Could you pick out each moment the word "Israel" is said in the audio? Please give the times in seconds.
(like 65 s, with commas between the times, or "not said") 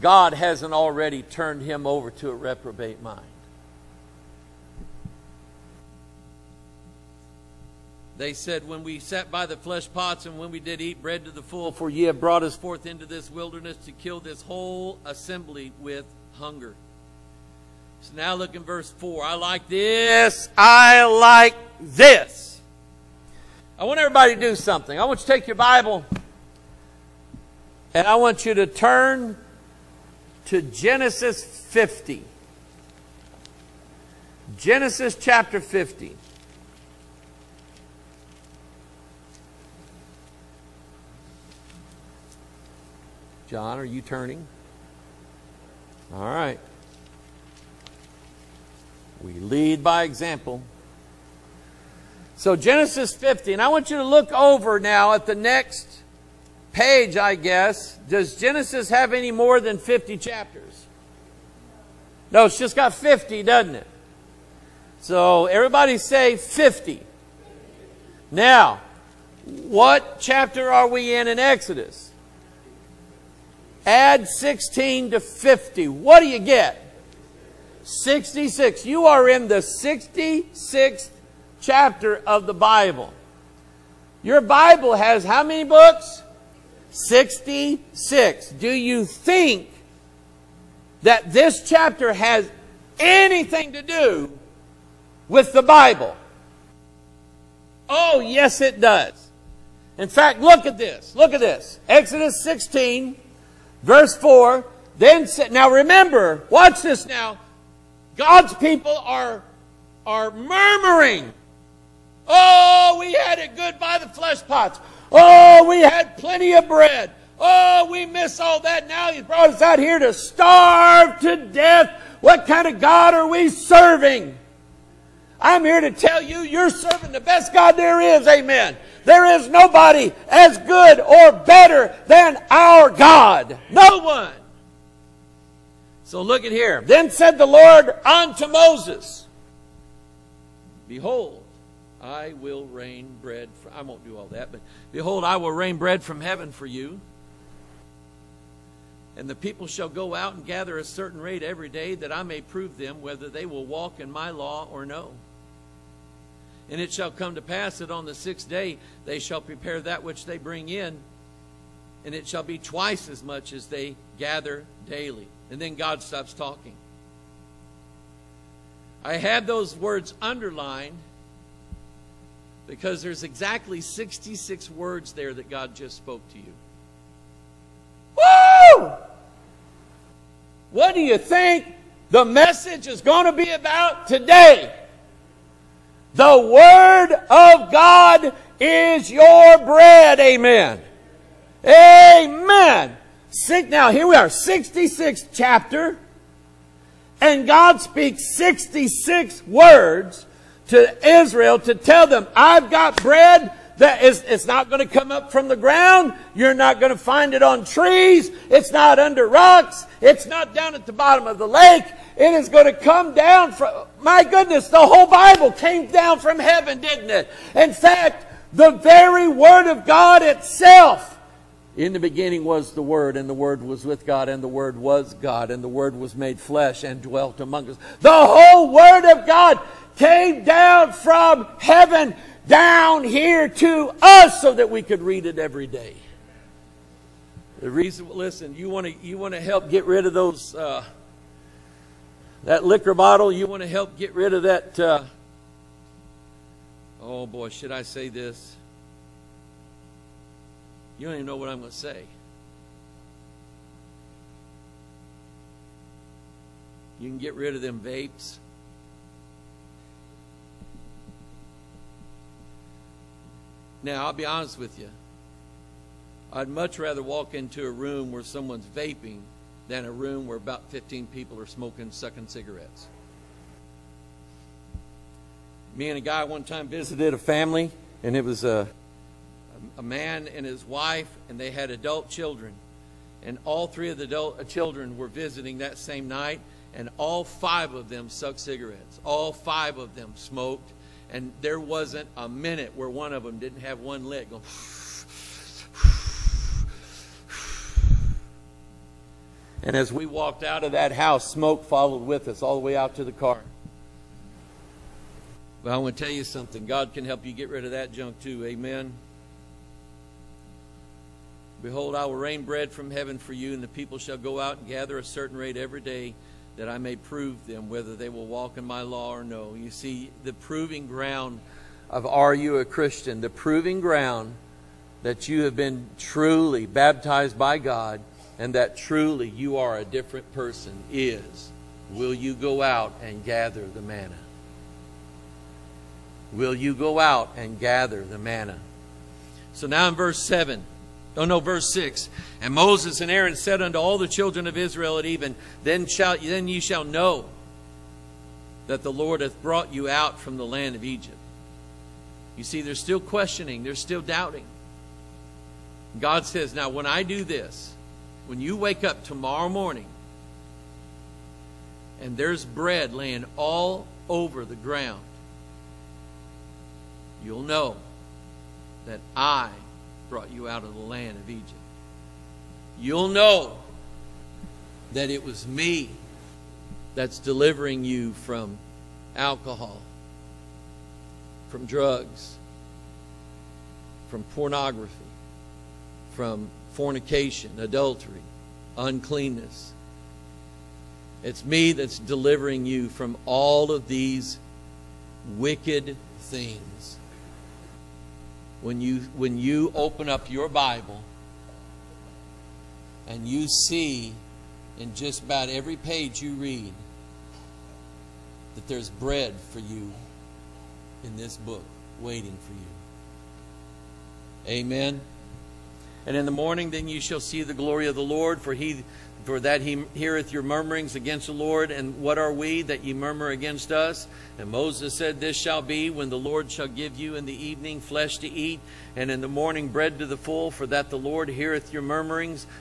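201 s, 344 s.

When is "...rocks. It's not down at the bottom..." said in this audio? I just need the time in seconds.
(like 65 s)
209 s.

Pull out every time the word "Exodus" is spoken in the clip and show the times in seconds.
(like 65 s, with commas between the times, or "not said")
71 s, 101 s.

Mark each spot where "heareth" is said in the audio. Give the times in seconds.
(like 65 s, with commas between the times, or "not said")
419 s, 431 s.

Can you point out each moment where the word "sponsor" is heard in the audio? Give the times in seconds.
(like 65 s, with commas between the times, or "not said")
not said.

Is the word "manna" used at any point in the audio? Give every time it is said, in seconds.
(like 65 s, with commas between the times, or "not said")
333 s, 338 s.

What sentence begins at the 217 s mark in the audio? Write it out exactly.
In fact, the very Word of God itself.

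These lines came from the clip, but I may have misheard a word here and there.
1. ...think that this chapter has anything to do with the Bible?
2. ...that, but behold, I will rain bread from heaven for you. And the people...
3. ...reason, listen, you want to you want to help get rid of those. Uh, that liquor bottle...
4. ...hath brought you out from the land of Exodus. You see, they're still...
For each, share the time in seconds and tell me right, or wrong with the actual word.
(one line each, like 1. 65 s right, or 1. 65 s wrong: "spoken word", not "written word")
1. 89 s right
2. 144 s right
3. 237 s right
4. 349 s wrong: "Egypt", not "Exodus".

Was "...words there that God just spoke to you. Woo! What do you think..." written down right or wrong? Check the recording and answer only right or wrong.
right.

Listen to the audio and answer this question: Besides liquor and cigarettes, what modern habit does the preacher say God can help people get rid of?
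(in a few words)
vapes.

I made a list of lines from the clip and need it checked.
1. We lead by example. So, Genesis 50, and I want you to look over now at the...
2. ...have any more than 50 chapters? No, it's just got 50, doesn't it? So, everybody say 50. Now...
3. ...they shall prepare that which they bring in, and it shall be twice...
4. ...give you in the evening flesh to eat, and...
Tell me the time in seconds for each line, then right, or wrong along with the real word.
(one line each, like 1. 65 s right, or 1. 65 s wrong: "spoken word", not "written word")
1. 49 s right
2. 58 s right
3. 159 s right
4. 426 s right.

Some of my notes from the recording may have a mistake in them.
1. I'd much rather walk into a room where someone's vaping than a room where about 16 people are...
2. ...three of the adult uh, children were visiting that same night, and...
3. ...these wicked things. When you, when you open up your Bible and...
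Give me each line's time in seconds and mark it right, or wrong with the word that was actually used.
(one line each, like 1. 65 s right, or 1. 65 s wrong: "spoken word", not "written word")
1. 266 s wrong: "15", not "16"
2. 283 s right
3. 393 s right.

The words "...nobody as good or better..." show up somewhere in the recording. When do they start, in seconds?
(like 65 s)
129 s.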